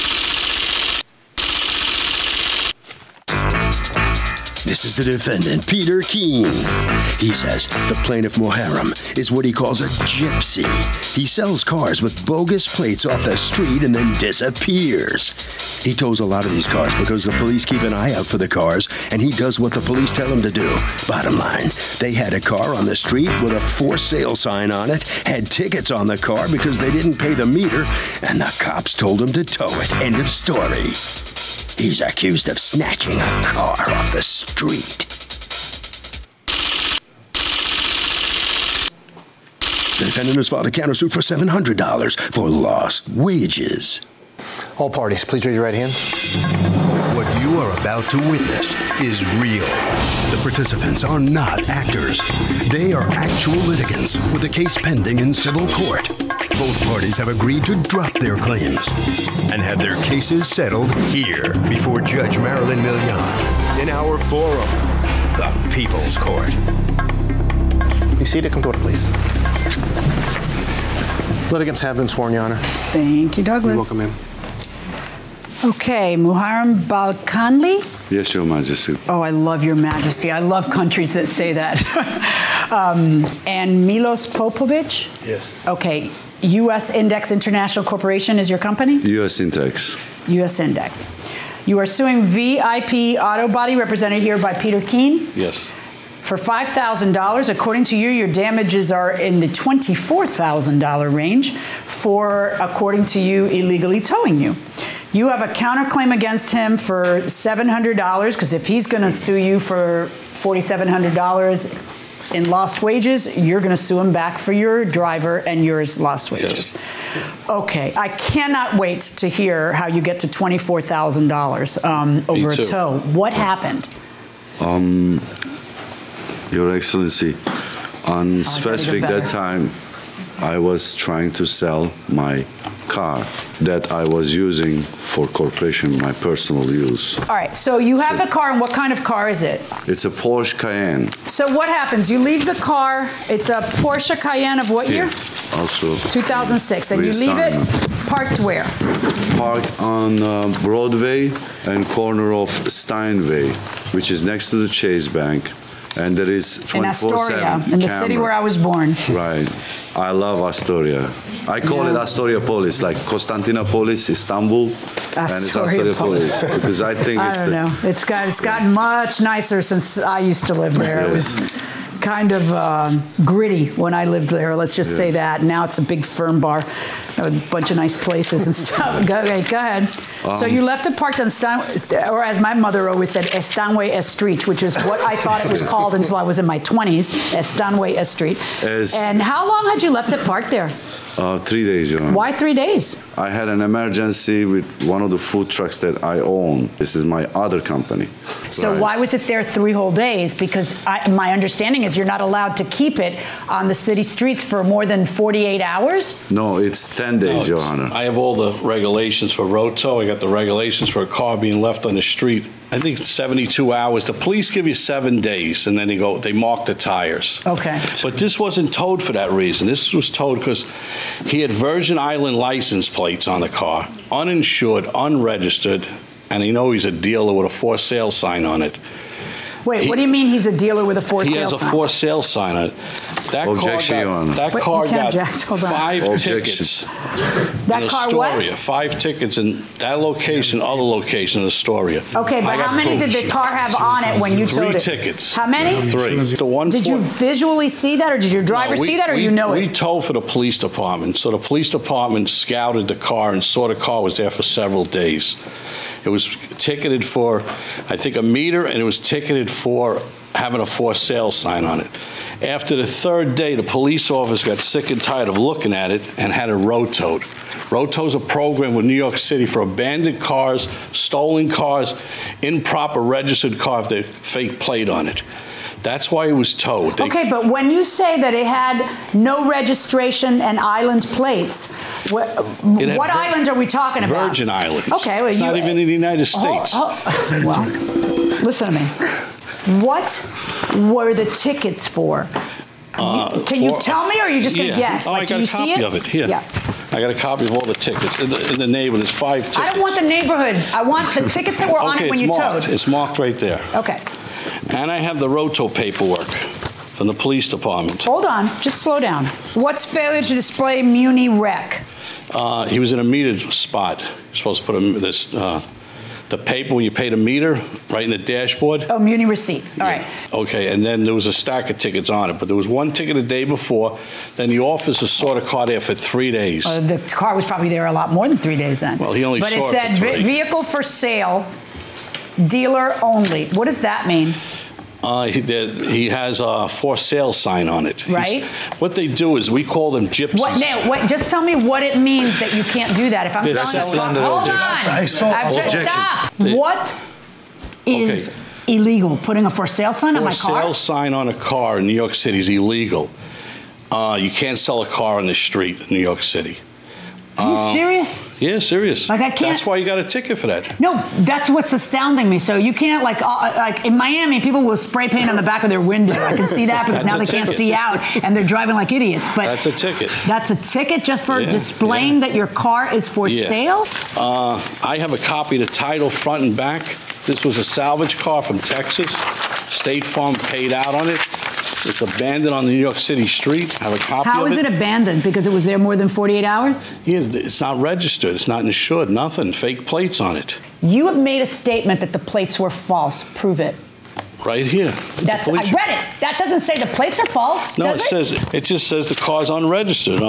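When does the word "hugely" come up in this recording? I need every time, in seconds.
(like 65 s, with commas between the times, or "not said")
not said.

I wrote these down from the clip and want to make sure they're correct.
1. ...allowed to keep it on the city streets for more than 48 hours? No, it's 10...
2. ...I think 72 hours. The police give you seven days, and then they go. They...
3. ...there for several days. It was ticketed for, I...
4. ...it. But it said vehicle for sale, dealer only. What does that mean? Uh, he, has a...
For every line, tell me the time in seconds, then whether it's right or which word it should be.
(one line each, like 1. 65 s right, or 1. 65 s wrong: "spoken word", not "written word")
1. 202 s right
2. 212 s right
3. 254 s right
4. 329 s right.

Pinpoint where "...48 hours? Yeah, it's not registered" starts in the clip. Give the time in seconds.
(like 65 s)
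386 s.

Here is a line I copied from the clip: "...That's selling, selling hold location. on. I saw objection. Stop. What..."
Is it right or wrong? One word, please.
wrong.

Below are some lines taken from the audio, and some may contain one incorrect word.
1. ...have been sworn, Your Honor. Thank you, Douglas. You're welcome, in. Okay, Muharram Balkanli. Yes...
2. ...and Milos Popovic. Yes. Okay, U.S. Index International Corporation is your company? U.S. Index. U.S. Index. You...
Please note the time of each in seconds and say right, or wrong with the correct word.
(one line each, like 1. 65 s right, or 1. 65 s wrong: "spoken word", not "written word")
1. 71 s right
2. 83 s right.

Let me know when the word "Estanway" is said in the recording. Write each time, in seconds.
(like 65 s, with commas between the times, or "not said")
183 s, 187 s.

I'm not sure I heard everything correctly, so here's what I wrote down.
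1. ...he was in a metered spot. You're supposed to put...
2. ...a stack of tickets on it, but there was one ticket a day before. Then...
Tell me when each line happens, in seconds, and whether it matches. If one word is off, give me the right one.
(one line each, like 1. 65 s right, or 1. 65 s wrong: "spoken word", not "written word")
1. 312 s right
2. 321 s right.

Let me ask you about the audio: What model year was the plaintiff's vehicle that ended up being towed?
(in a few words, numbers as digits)
2006.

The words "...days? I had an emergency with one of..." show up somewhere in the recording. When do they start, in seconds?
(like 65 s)
192 s.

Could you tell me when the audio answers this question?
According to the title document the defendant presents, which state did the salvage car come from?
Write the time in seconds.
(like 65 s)
378 s.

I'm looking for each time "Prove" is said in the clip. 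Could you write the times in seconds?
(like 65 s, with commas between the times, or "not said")
393 s.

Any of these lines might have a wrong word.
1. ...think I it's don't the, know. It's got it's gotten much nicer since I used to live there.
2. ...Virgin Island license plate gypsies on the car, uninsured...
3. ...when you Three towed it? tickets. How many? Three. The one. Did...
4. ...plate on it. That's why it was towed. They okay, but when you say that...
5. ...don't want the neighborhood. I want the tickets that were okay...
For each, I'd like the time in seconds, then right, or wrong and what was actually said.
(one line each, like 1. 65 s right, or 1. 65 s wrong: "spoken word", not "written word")
1. 166 s right
2. 221 s wrong: "plates", not "gypsies"
3. 244 s right
4. 274 s right
5. 299 s right.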